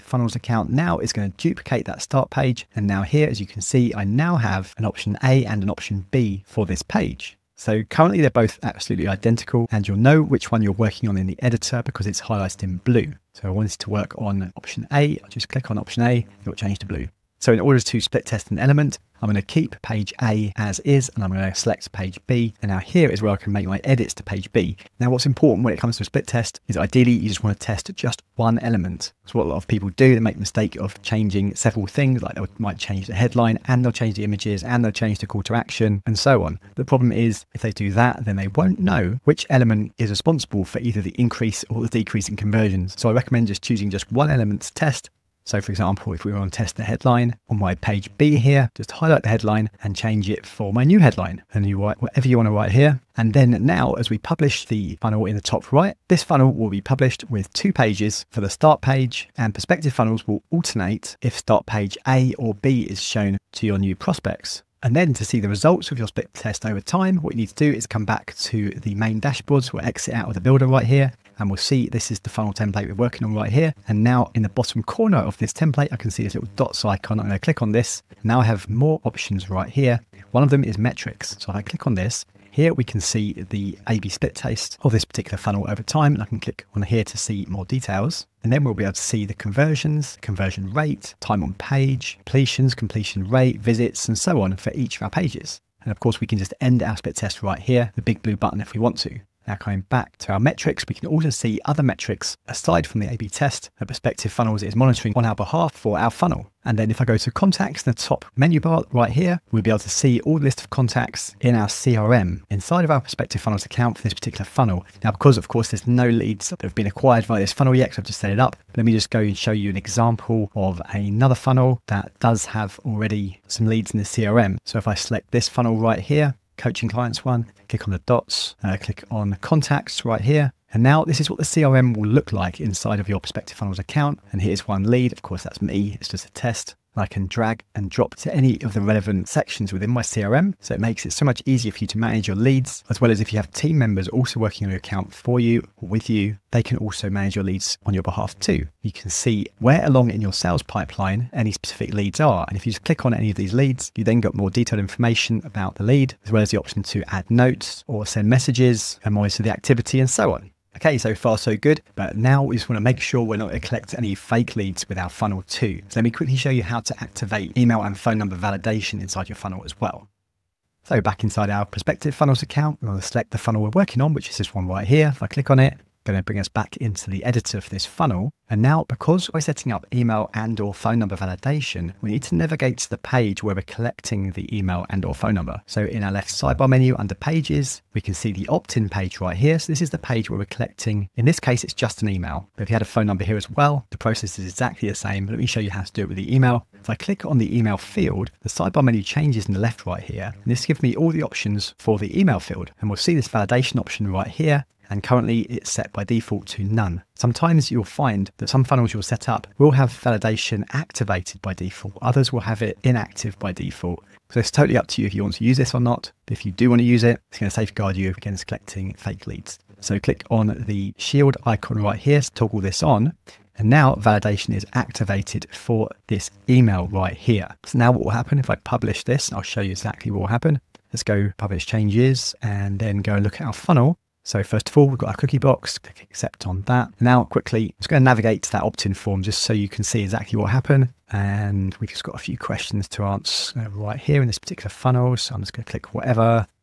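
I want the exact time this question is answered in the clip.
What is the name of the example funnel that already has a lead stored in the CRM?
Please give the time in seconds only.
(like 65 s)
126 s.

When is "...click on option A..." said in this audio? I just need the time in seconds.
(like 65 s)
15 s.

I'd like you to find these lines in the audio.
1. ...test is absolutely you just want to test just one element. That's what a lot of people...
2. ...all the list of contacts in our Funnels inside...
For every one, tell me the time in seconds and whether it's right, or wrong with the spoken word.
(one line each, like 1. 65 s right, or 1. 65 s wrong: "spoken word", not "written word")
1. 26 s wrong: "ideally", not "absolutely"
2. 110 s wrong: "CRM", not "Funnels".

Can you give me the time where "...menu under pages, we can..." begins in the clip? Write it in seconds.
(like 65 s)
186 s.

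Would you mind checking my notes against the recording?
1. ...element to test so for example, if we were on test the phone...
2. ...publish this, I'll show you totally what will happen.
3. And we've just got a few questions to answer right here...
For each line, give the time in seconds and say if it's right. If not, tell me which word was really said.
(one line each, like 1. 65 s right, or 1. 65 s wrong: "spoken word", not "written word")
1. 44 s wrong: "headline", not "phone"
2. 228 s wrong: "exactly", not "totally"
3. 241 s right.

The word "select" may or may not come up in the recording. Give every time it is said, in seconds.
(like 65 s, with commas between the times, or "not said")
21 s, 124 s, 173 s.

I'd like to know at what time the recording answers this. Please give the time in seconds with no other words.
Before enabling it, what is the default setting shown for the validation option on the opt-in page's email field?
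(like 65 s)
206 s.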